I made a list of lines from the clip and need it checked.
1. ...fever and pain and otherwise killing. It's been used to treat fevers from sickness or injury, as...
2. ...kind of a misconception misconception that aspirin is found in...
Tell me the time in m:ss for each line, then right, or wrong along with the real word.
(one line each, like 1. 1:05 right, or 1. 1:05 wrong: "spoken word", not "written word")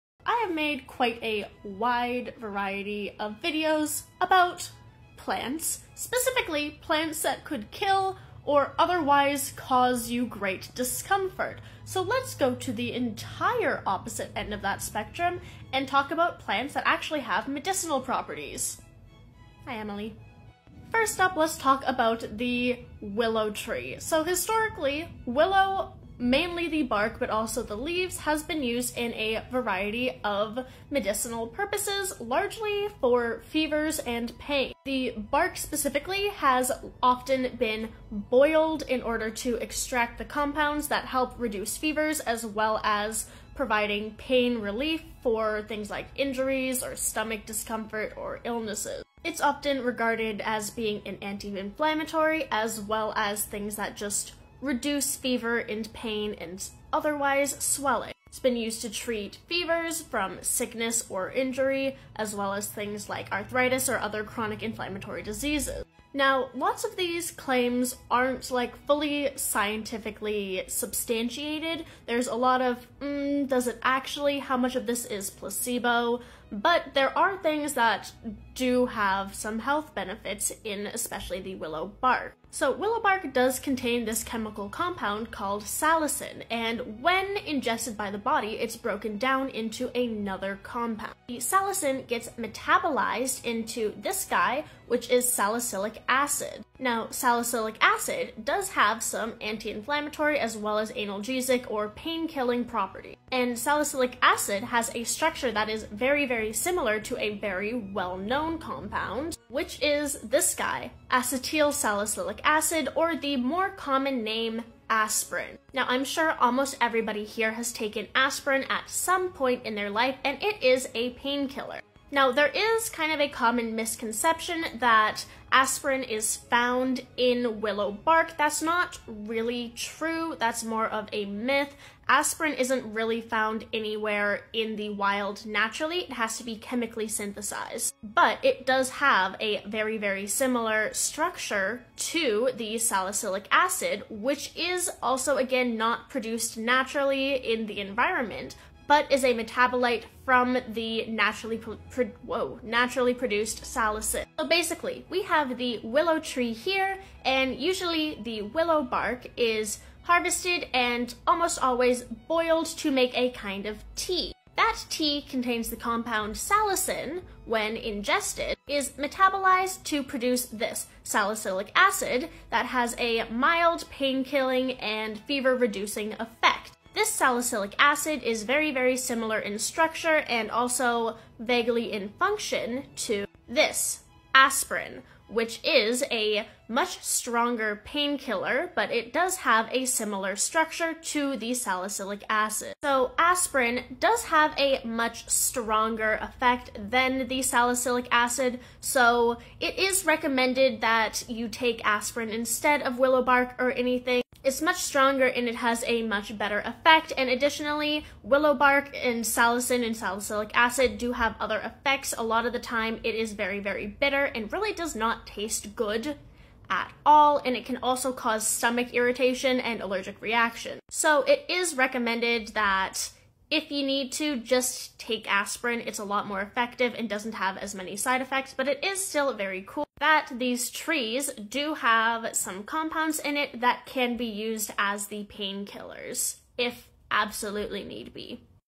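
1. 0:55 wrong: "swelling", not "killing"
2. 2:02 wrong: "common", not "misconception".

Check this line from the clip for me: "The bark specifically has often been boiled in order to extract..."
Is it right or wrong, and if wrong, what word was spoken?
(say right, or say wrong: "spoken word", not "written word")
right.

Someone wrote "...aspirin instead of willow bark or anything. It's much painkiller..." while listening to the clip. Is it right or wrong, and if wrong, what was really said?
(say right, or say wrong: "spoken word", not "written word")
wrong: "stronger", not "painkiller".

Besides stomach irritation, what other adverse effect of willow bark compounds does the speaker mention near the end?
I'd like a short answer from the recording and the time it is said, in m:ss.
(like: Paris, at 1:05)
allergic reaction, at 3:39.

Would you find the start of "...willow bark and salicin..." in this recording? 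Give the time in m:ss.
3:28.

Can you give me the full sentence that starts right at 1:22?
So willow bark does contain this chemical compound called salicin, and when ingested by the body, it's broken down into another compound.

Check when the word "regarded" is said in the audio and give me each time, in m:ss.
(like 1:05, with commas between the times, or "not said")
0:49.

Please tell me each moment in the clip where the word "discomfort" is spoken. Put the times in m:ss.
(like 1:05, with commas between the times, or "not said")
0:10, 0:47.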